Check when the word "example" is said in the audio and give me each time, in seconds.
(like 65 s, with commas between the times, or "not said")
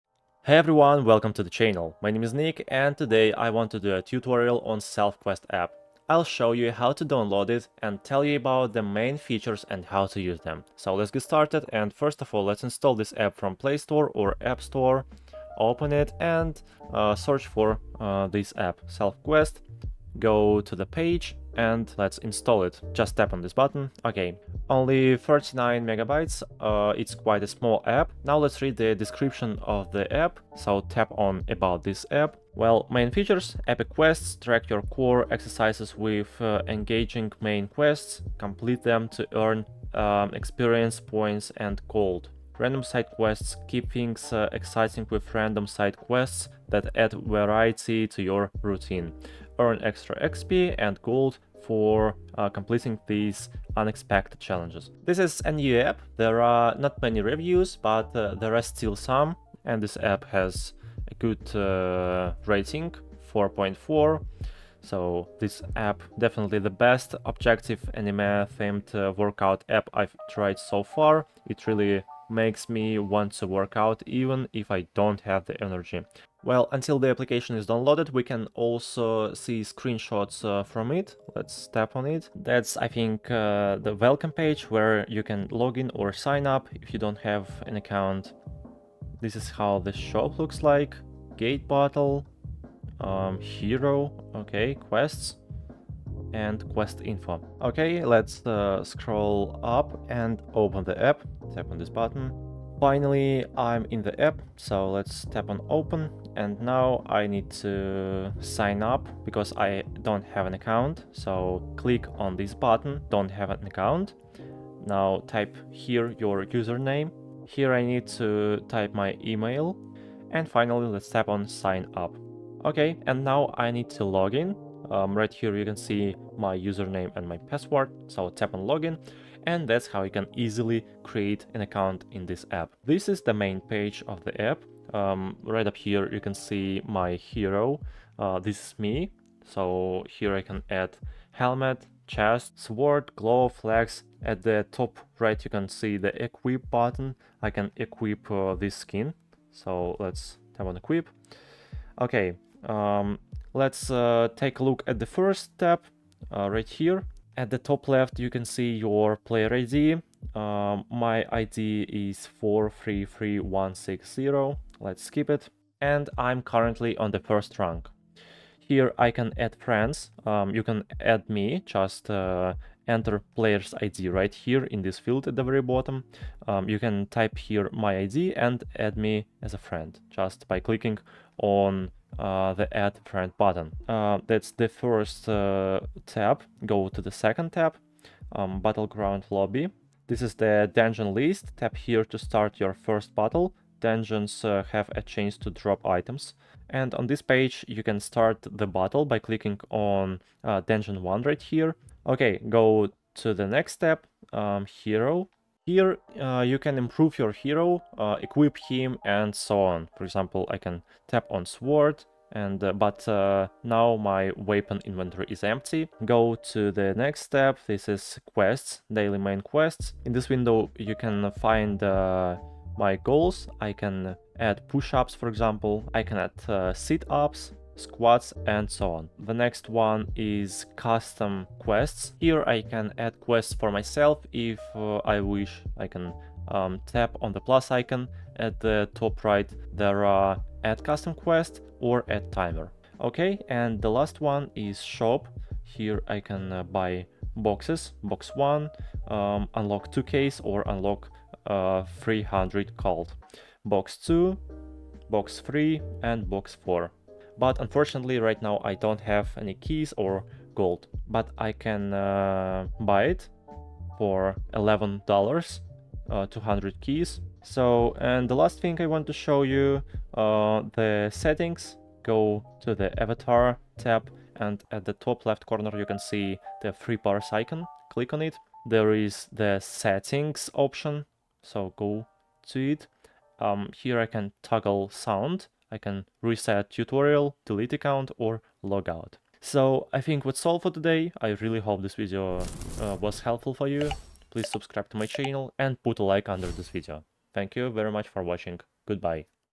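210 s, 225 s.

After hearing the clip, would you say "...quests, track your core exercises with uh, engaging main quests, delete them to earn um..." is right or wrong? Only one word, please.
wrong.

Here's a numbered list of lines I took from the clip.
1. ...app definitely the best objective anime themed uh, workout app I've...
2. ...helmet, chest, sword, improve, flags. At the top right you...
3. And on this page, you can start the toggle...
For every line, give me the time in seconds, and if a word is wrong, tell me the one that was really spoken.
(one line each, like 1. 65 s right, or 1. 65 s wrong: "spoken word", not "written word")
1. 65 s right
2. 141 s wrong: "glove", not "improve"
3. 196 s wrong: "battle", not "toggle".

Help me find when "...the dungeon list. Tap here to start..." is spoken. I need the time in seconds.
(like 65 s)
190 s.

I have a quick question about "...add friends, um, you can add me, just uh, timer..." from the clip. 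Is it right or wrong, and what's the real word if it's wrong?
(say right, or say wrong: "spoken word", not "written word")
wrong: "enter", not "timer".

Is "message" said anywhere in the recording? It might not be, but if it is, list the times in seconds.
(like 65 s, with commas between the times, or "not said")
not said.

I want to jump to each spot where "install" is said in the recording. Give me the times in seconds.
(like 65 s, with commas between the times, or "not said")
12 s, 22 s.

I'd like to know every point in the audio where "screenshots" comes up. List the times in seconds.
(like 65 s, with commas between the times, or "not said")
79 s.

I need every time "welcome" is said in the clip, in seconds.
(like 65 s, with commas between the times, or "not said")
1 s, 83 s.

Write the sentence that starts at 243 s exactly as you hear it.
Okay, and the last one is shop.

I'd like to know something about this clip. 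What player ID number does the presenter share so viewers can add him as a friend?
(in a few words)
433160.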